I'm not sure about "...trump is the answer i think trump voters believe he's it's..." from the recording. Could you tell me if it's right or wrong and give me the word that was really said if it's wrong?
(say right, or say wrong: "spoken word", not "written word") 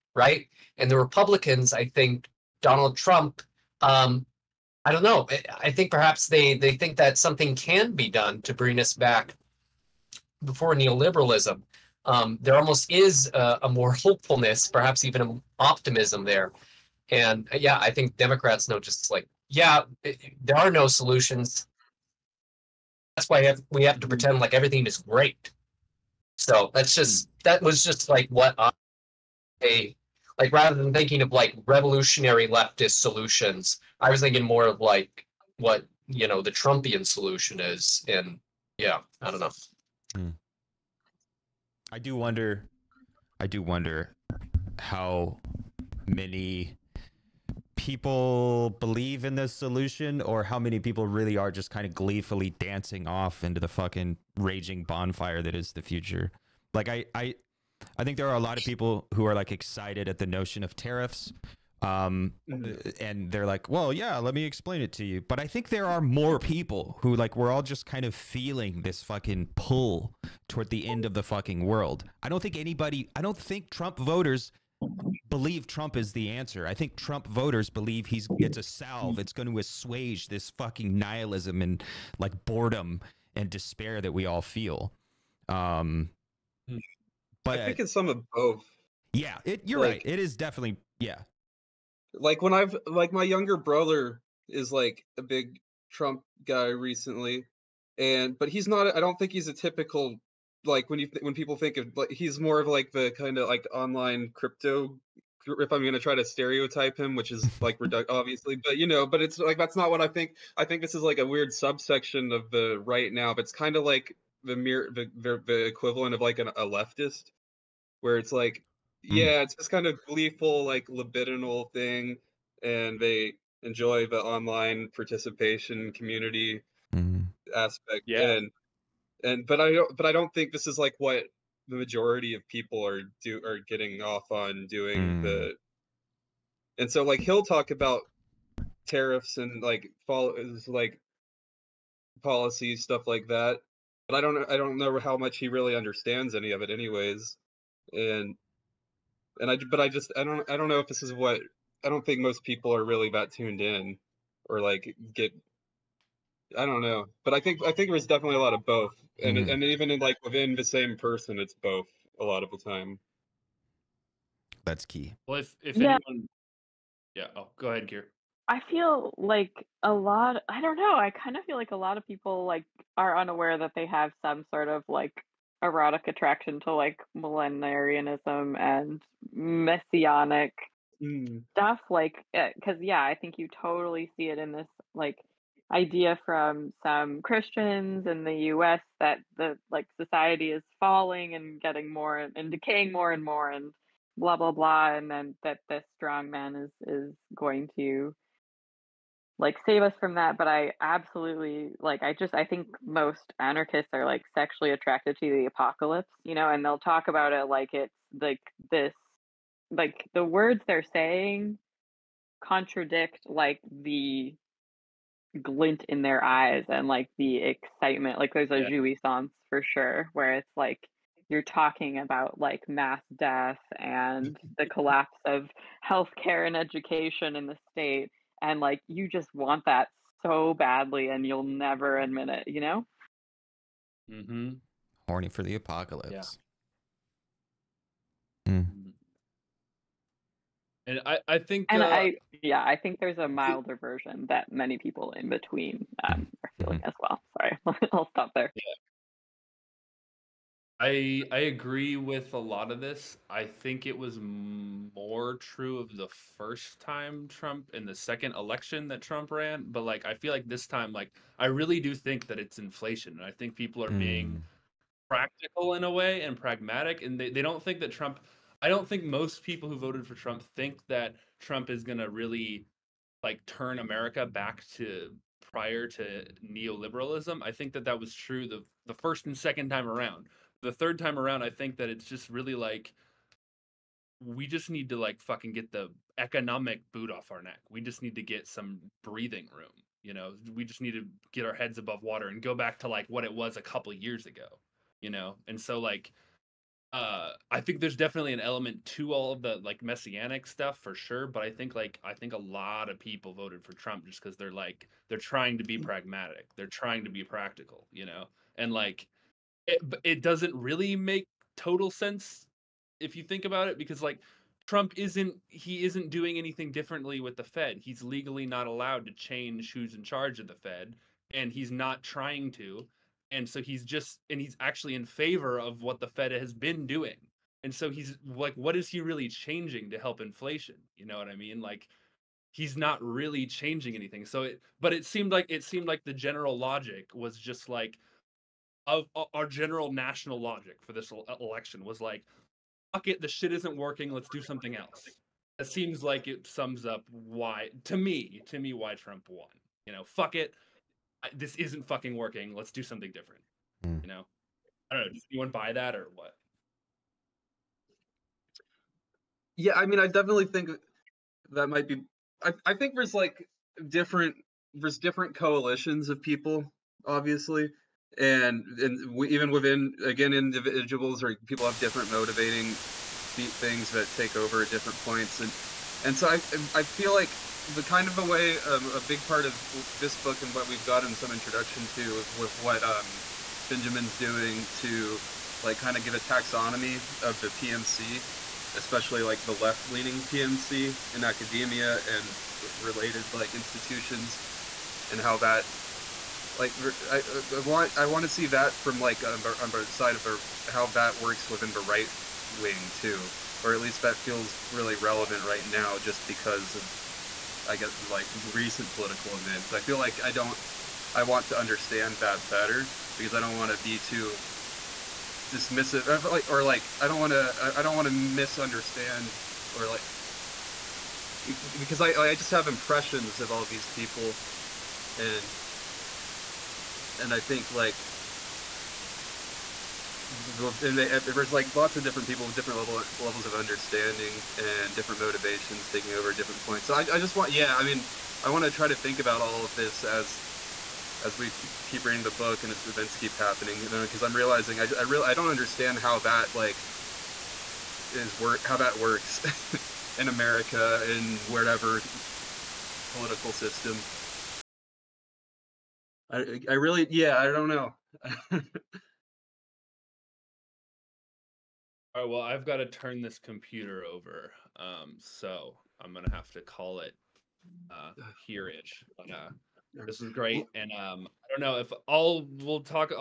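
right.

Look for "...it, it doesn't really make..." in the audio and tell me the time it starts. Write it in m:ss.
5:09.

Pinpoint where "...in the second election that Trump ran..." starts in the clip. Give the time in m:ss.
4:17.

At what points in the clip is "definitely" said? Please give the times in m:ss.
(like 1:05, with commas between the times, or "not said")
1:30, 2:38, 4:57, 6:00.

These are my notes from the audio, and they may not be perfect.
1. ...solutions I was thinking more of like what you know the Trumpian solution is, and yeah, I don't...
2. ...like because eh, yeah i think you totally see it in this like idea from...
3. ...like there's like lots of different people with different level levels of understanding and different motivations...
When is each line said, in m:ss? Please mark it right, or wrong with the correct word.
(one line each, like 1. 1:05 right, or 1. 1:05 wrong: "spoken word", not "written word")
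1. 0:33 right
2. 3:01 right
3. 7:07 right.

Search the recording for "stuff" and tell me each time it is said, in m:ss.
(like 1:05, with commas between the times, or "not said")
2:22, 3:01, 5:00.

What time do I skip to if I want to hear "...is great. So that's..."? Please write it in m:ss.
0:24.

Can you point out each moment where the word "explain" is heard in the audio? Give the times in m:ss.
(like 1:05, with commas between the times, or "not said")
1:04.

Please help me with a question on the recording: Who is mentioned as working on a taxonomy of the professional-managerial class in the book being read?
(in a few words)
Benjamin.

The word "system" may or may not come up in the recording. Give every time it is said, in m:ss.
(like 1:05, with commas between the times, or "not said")
7:33.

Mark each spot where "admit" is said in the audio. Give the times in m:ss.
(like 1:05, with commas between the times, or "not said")
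3:51.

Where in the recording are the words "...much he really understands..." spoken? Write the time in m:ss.
2:25.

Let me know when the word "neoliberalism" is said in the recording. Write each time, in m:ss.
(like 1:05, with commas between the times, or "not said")
0:10, 4:36.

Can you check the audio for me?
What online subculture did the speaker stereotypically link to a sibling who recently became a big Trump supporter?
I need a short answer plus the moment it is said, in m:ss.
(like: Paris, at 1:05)
Crypto, at 1:44.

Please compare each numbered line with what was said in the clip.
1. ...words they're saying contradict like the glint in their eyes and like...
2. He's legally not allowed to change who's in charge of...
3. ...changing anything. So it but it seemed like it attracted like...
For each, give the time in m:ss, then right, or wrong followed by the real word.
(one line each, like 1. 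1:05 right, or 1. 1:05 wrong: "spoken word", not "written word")
1. 3:30 right
2. 5:17 right
3. 5:33 wrong: "seemed", not "attracted".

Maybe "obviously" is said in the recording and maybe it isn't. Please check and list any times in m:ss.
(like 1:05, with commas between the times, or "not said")
1:48, 6:07.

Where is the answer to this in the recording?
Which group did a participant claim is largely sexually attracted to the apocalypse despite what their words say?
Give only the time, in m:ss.
3:23.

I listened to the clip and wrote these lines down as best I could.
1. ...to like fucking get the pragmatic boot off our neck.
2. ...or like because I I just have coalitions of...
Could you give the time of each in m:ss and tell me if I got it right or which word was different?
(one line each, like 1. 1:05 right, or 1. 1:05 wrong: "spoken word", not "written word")
1. 4:44 wrong: "economic", not "pragmatic"
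2. 6:59 wrong: "impressions", not "coalitions".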